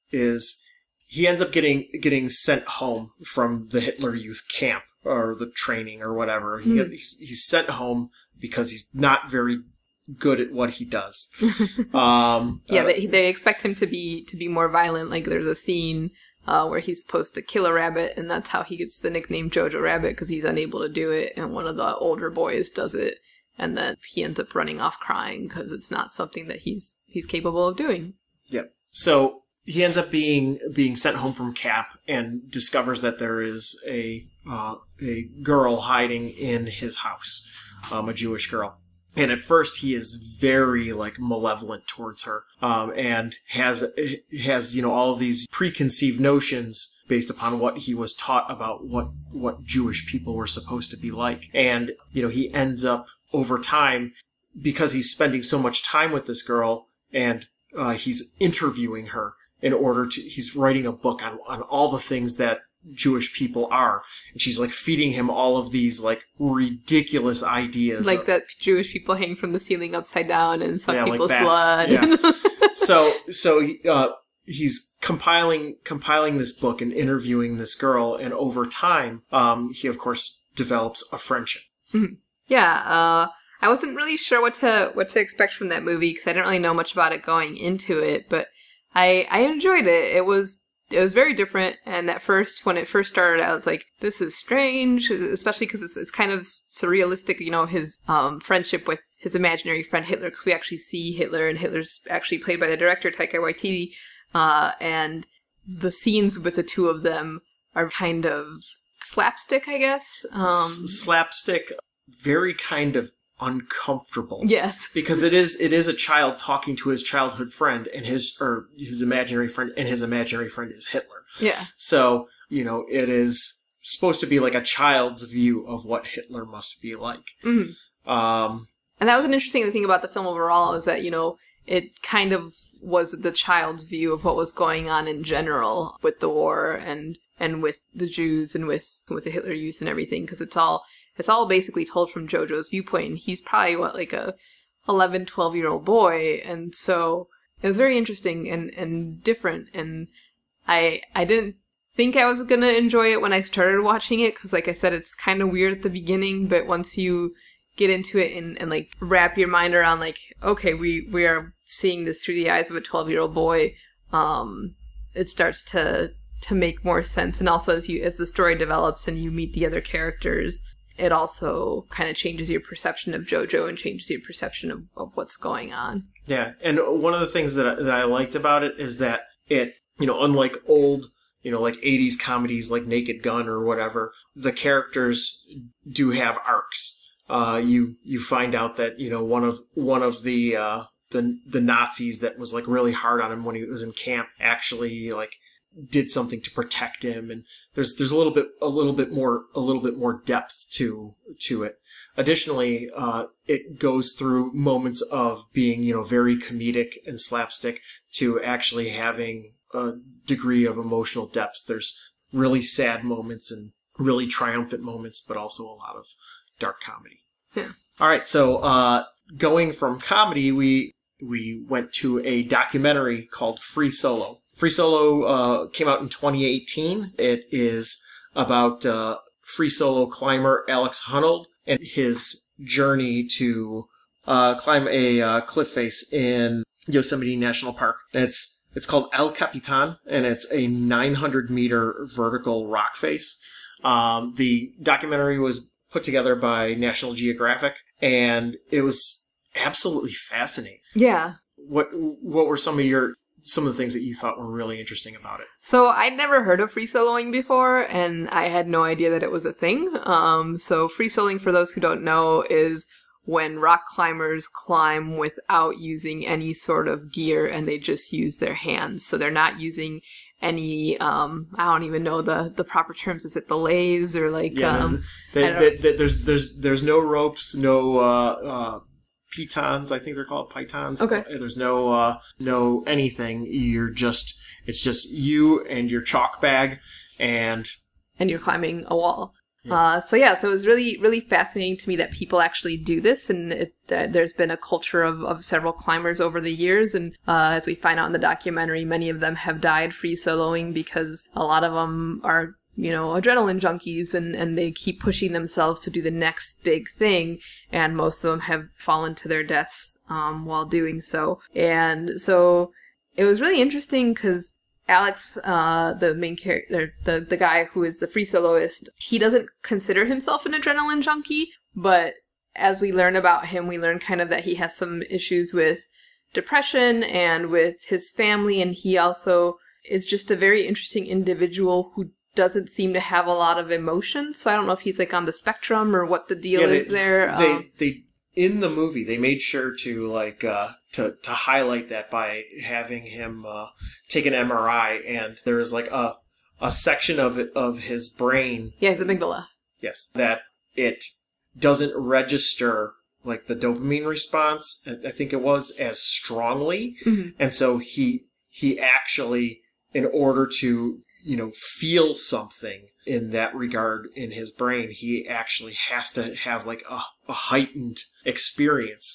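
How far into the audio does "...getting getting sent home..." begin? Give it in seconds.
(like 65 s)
1 s.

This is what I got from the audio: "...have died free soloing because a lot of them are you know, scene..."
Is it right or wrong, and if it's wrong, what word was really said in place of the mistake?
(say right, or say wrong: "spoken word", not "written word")
wrong: "adrenaline", not "scene".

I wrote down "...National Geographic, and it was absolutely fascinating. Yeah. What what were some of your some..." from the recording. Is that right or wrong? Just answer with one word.
right.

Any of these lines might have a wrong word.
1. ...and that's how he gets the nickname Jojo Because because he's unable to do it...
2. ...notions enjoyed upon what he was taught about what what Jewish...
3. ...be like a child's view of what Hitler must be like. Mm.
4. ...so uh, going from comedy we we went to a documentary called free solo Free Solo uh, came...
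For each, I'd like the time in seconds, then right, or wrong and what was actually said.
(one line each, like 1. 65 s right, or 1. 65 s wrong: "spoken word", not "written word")
1. 18 s wrong: "Rabbit", not "Because"
2. 46 s wrong: "based", not "enjoyed"
3. 124 s right
4. 218 s right.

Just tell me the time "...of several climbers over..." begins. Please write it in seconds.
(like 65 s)
295 s.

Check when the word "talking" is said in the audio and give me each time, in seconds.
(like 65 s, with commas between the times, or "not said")
116 s.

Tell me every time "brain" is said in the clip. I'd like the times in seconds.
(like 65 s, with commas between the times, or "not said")
348 s, 364 s.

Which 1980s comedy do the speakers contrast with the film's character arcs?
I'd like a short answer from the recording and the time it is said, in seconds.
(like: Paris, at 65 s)
Naked Gun, at 182 s.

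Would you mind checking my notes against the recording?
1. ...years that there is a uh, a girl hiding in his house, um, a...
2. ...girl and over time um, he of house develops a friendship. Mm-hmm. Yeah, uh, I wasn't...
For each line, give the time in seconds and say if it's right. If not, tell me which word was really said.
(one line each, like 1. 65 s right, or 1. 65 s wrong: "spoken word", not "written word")
1. 32 s wrong: "discovers", not "years"
2. 77 s wrong: "course", not "house".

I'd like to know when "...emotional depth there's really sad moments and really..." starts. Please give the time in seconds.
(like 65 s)
210 s.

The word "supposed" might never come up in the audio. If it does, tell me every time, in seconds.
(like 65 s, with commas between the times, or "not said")
17 s, 50 s, 123 s.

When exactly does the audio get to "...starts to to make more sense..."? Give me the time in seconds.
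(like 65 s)
165 s.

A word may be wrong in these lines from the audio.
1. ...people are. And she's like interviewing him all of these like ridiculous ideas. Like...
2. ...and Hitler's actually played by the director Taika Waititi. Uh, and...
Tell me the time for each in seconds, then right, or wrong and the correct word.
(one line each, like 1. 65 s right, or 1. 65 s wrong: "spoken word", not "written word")
1. 63 s wrong: "feeding", not "interviewing"
2. 101 s right.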